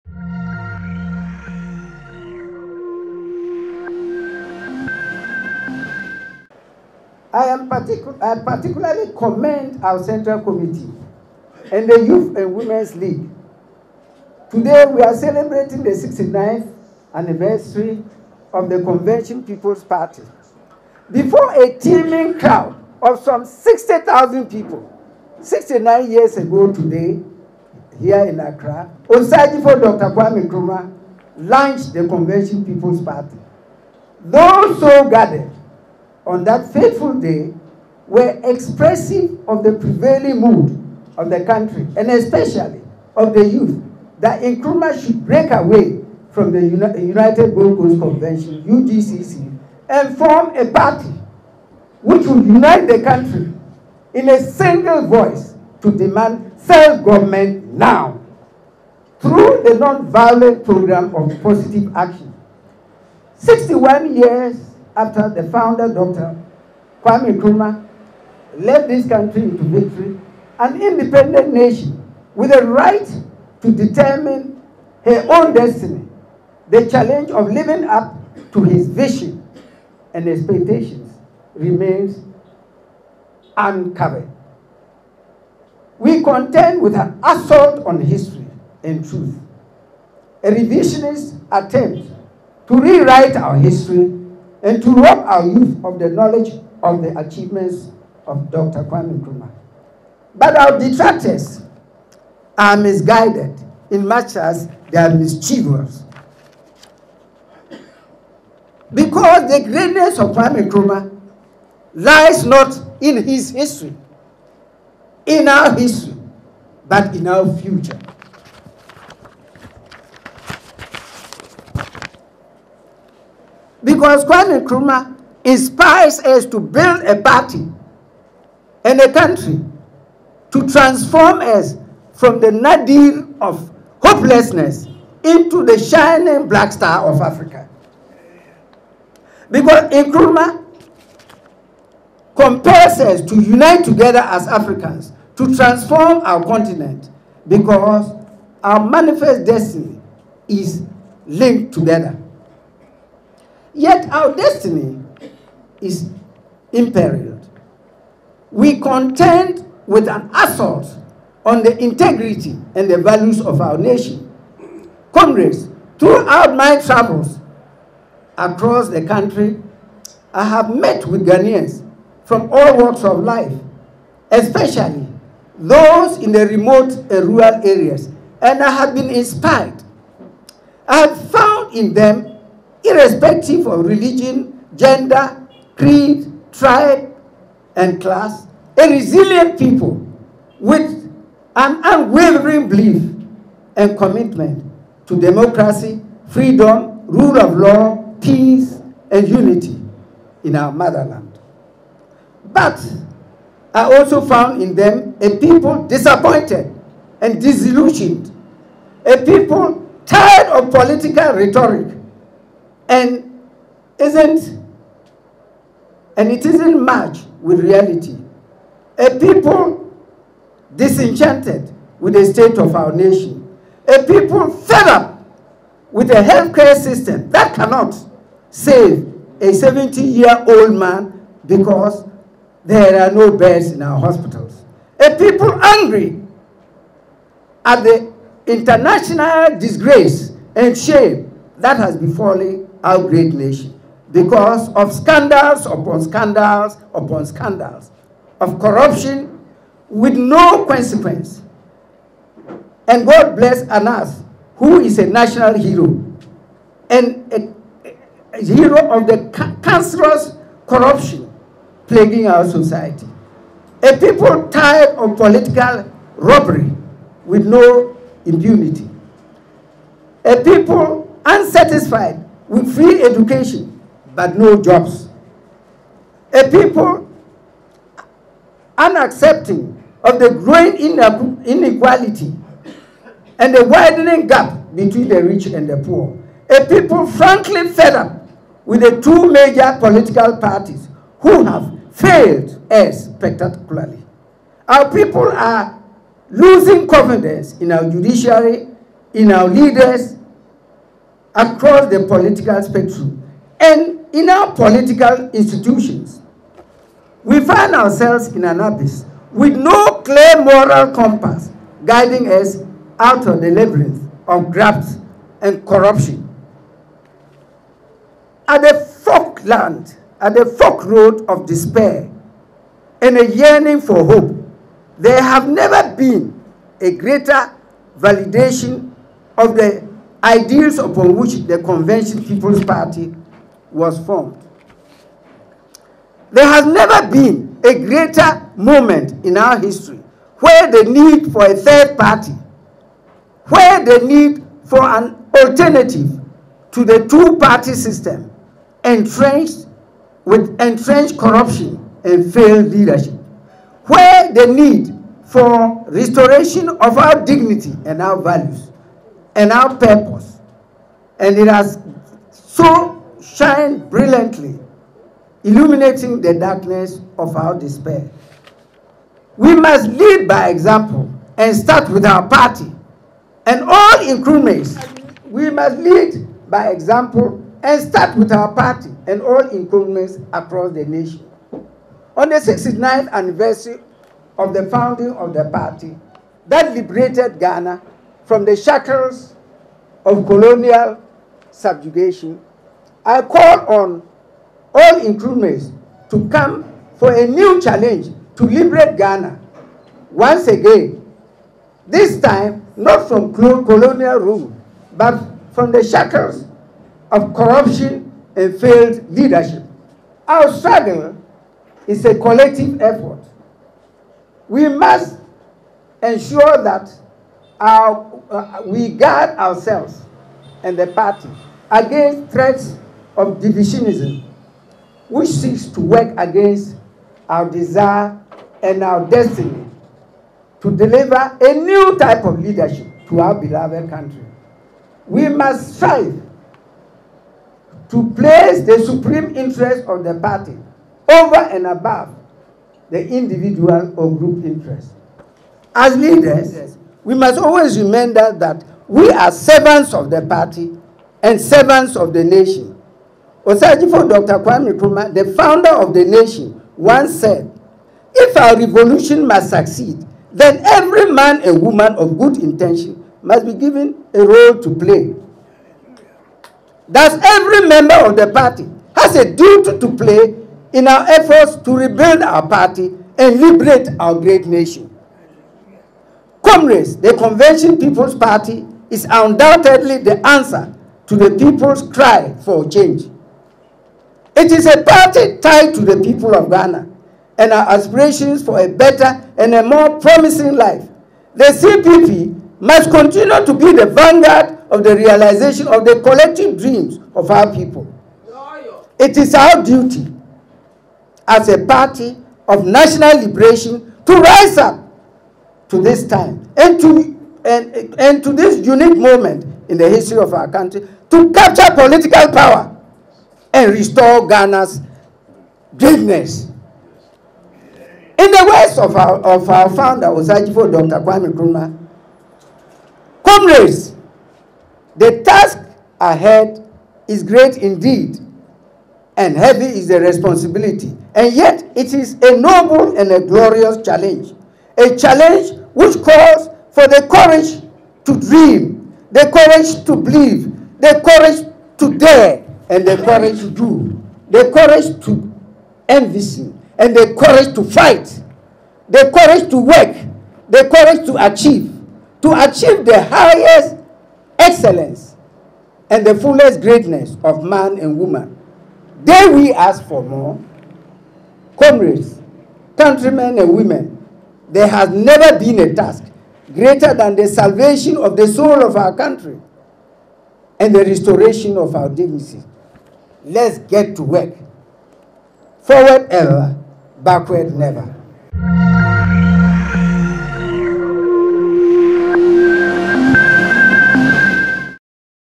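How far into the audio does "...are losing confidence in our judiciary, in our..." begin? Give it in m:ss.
4:55.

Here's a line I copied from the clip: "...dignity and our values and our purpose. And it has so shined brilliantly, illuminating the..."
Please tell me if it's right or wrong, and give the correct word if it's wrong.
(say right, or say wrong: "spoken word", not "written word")
right.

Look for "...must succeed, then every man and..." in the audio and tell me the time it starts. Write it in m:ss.
7:39.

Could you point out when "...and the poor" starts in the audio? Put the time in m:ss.
4:45.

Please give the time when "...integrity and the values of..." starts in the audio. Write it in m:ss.
2:41.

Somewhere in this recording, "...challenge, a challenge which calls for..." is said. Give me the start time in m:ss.
8:53.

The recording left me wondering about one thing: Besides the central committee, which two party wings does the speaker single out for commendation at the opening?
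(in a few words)
Youth and Women's League.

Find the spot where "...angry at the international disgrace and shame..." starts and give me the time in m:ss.
3:55.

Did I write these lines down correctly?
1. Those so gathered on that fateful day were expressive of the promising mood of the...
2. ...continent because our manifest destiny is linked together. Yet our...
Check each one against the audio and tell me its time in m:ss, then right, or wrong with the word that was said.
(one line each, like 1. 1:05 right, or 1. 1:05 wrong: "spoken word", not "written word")
1. 0:34 wrong: "prevailing", not "promising"
2. 2:26 right.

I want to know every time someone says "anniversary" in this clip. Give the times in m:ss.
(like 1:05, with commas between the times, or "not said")
0:17, 6:23.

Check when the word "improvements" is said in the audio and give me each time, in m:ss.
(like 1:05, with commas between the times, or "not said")
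6:19, 6:35.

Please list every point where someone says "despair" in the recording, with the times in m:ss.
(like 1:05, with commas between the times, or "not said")
5:21, 6:07.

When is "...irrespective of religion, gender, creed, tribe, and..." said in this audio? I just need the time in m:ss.
3:02.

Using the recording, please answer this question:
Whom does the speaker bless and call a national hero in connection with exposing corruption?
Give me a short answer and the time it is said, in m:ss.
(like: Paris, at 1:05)
Anas, at 4:13.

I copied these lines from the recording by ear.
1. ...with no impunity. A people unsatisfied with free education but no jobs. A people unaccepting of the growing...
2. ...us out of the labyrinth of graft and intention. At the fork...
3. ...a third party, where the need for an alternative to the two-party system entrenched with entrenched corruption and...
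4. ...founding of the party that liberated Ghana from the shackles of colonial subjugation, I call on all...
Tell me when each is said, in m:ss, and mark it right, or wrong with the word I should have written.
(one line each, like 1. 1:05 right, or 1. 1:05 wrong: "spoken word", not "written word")
1. 4:27 right
2. 5:12 wrong: "corruption", not "intention"
3. 5:41 right
4. 6:24 right.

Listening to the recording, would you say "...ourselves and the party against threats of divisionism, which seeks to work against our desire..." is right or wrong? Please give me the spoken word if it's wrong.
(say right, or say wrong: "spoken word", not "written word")
right.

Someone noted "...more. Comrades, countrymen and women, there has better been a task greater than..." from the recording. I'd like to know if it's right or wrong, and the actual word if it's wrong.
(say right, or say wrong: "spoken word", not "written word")
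wrong: "never", not "better".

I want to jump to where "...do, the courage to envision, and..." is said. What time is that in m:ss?
9:03.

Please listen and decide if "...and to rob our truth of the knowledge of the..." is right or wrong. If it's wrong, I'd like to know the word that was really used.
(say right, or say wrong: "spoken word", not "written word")
wrong: "youth", not "truth".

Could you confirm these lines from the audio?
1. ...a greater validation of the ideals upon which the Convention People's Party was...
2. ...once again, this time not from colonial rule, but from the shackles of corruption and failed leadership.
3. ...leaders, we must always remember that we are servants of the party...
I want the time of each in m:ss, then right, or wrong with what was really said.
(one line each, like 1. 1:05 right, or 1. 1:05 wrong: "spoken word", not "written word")
1. 5:26 right
2. 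6:40 right
3. 7:25 right.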